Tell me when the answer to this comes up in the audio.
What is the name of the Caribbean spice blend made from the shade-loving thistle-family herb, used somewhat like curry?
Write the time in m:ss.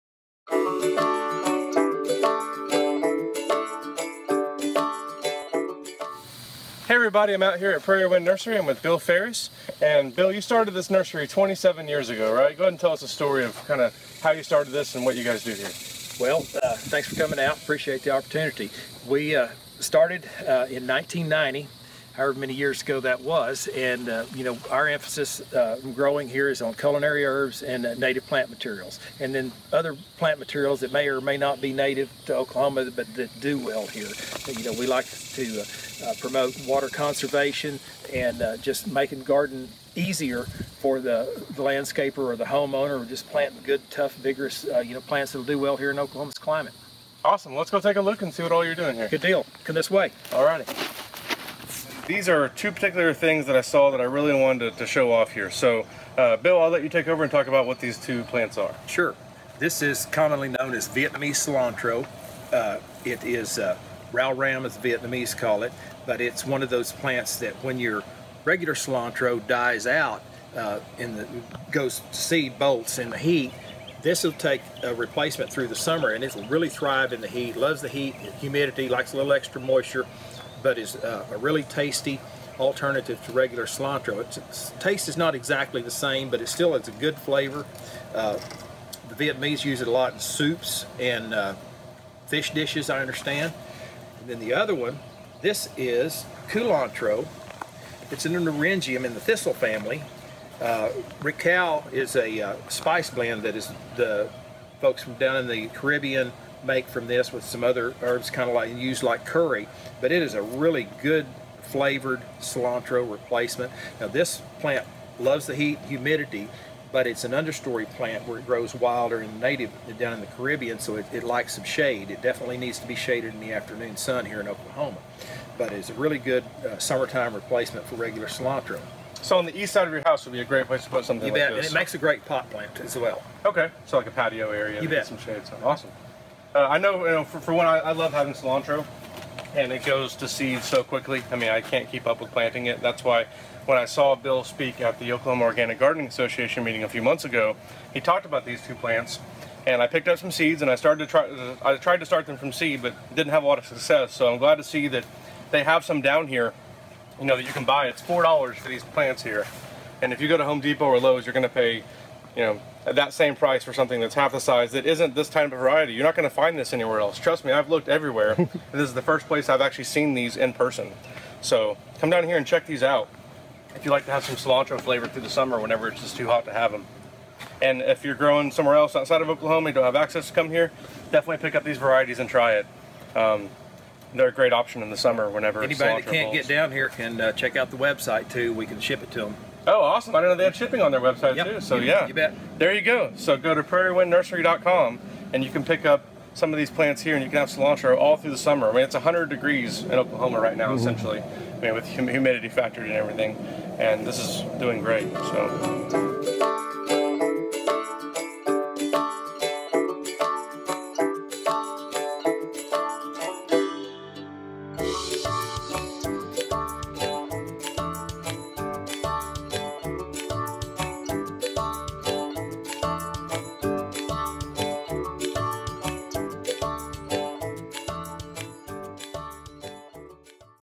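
1:41.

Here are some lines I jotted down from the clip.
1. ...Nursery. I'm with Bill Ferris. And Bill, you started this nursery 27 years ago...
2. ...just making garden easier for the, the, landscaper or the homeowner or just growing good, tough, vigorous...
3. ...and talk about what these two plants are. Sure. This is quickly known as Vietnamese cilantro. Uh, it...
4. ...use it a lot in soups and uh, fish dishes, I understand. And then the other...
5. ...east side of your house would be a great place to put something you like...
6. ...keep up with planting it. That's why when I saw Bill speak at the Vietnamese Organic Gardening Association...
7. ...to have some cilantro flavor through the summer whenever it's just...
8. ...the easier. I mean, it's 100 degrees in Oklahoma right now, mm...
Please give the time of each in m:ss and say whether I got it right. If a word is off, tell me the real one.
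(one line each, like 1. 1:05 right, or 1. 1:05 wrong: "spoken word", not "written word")
1. 0:08 right
2. 0:38 wrong: "planting", not "growing"
3. 0:57 wrong: "commonly", not "quickly"
4. 1:29 right
5. 2:09 right
6. 2:21 wrong: "Oklahoma", not "Vietnamese"
7. 2:54 right
8. 3:18 wrong: "summer", not "easier".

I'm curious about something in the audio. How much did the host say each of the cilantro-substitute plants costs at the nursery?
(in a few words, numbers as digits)
$4.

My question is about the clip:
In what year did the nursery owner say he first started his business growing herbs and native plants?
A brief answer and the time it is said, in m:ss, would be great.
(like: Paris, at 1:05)
1990, at 0:20.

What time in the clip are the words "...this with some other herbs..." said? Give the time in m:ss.
1:47.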